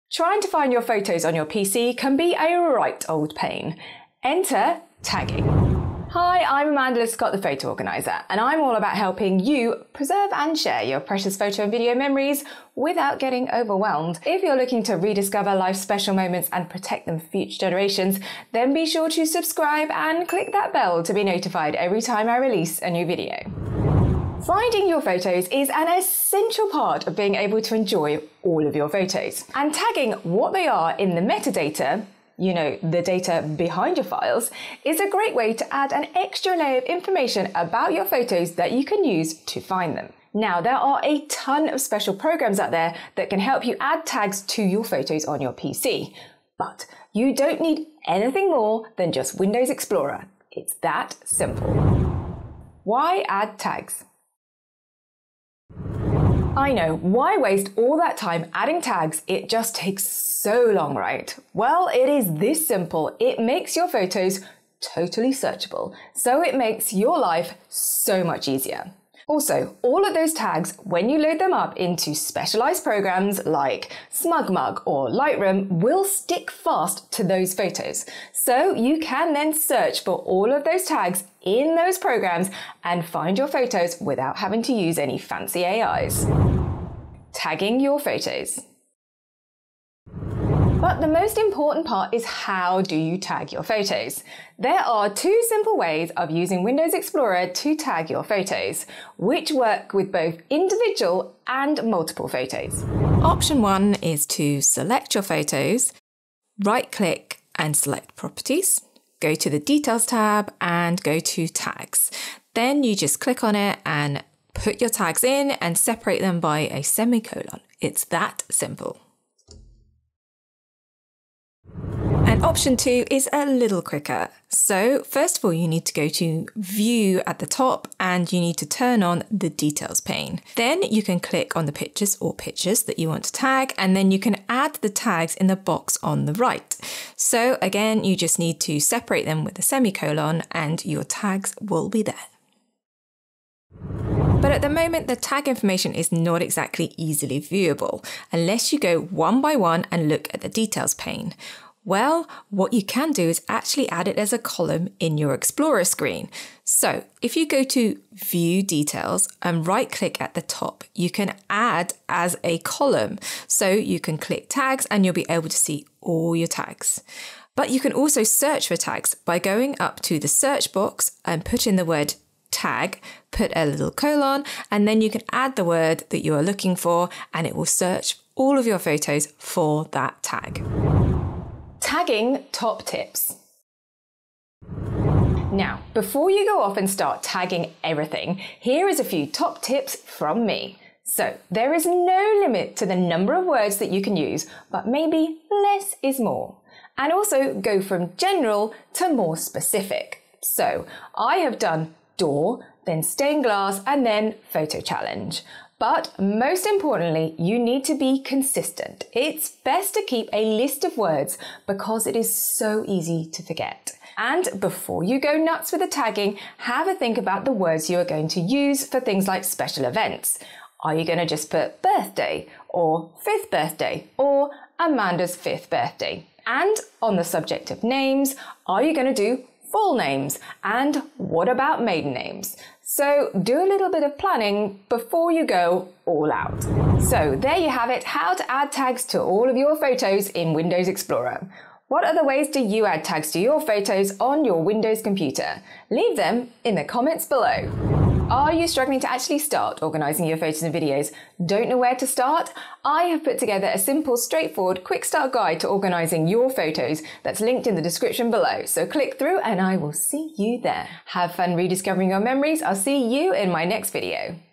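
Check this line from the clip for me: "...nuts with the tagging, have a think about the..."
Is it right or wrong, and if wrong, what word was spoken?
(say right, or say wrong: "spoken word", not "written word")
right.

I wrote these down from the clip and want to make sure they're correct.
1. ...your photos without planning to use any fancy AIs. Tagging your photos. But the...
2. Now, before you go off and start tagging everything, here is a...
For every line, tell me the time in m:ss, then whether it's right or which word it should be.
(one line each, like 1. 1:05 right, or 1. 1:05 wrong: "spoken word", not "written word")
1. 1:23 wrong: "having", not "planning"
2. 3:05 right.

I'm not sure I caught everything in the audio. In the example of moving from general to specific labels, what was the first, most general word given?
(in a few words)
Door.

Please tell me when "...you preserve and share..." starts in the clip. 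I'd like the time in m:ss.
0:09.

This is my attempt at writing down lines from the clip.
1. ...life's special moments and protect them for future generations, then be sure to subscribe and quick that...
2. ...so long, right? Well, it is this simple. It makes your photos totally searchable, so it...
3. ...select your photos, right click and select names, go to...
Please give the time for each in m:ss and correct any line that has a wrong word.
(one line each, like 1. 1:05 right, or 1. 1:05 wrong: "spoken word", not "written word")
1. 0:15 wrong: "click", not "quick"
2. 1:00 right
3. 1:44 wrong: "properties", not "names".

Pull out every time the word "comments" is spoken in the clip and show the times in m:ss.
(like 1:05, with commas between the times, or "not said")
4:06.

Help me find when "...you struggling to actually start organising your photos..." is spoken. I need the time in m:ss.
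4:08.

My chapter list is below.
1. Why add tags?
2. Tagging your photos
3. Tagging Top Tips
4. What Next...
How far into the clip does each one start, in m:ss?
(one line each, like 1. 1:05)
1. 0:53
2. 1:27
3. 3:02
4. 4:08.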